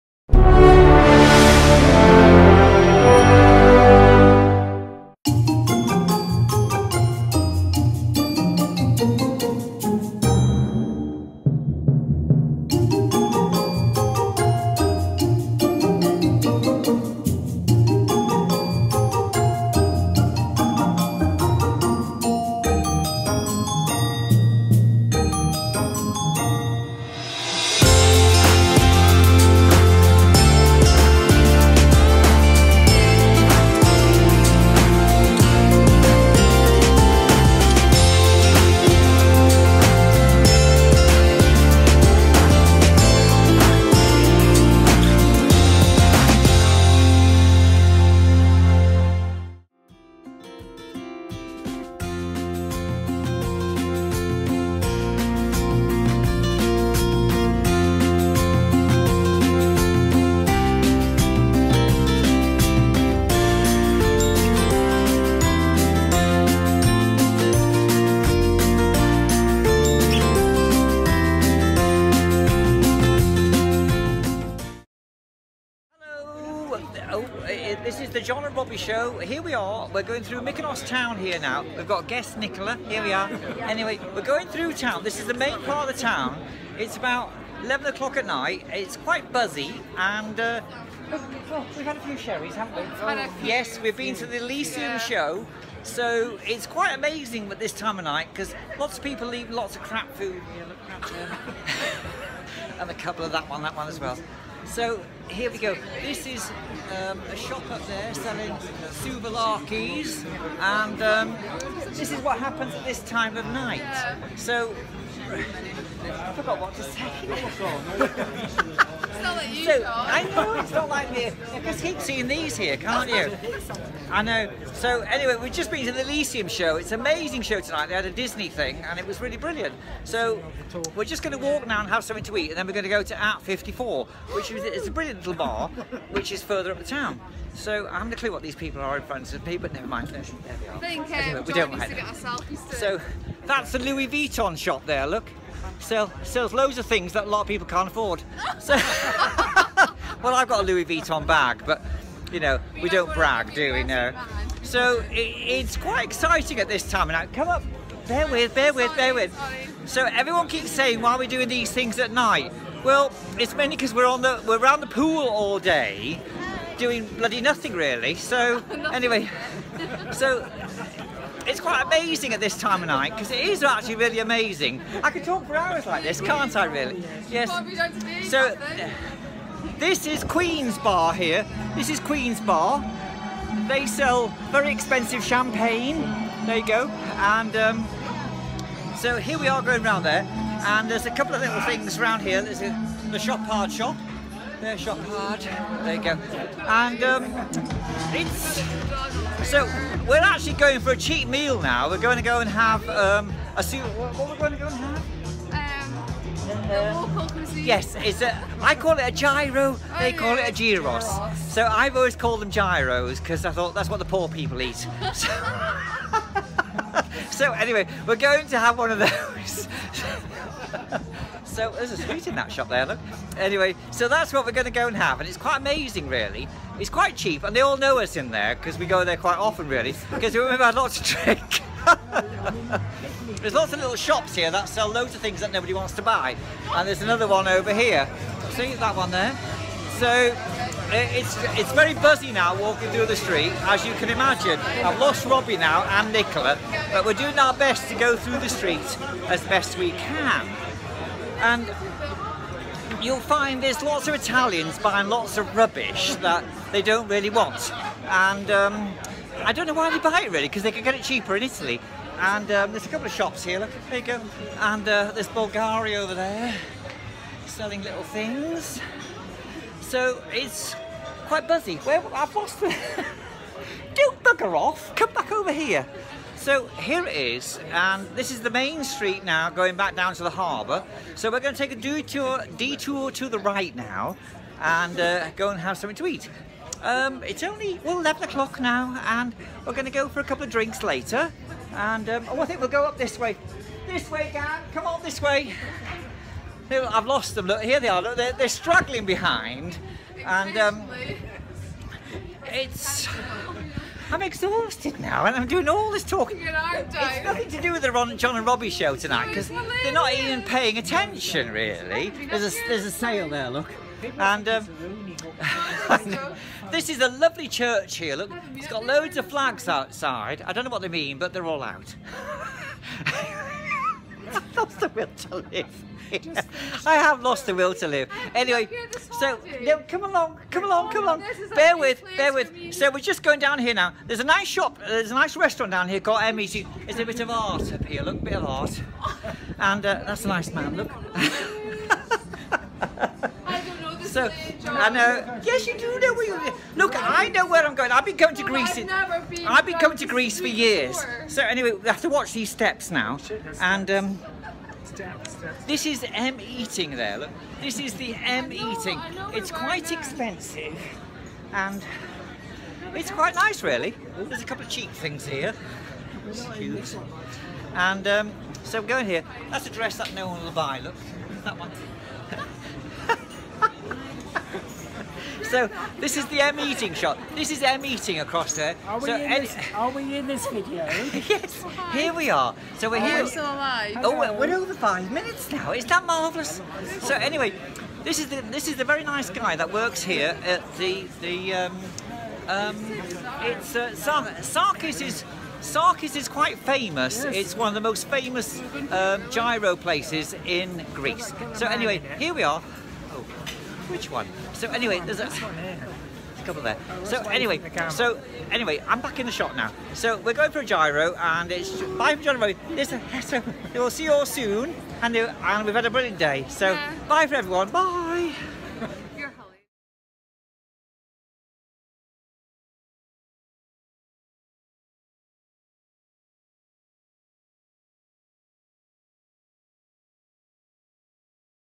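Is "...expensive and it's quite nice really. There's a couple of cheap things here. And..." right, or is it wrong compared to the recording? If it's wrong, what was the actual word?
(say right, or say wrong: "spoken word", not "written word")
right.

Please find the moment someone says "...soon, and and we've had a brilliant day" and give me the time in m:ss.
6:54.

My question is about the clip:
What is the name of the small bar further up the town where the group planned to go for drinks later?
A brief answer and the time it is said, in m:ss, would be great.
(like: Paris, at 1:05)
At 54, at 2:13.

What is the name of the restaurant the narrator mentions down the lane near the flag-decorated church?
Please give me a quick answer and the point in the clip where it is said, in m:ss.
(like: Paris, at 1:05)
Emmy's, at 5:36.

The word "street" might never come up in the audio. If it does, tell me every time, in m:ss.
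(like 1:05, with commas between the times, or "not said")
4:03, 4:08, 4:38.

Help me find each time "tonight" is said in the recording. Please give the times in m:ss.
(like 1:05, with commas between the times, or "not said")
2:07, 5:08.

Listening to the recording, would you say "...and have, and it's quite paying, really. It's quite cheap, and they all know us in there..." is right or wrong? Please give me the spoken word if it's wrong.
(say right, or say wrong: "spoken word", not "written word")
wrong: "amazing", not "paying".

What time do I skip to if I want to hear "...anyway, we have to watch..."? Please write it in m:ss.
5:51.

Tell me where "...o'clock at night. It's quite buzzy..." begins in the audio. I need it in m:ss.
1:27.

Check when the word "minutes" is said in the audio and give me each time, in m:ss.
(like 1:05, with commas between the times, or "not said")
6:25.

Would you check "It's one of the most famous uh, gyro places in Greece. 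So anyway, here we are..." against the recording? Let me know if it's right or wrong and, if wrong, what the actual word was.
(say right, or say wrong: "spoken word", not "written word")
right.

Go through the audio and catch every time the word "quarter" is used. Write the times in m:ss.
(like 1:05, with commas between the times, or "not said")
not said.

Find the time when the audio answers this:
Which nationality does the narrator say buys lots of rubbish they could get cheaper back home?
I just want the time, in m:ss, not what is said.
4:14.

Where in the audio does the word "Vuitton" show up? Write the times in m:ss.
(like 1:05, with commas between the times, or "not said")
2:24, 2:30.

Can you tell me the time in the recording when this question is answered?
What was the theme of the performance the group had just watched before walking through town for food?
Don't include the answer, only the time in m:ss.
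2:08.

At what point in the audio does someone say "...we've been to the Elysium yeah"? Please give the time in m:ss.
1:33.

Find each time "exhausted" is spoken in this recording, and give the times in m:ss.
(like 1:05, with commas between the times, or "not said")
5:04.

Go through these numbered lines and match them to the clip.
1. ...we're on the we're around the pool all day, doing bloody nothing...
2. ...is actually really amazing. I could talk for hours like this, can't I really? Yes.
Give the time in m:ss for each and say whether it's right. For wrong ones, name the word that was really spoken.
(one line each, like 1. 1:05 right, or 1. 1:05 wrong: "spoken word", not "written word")
1. 2:43 right
2. 2:53 right.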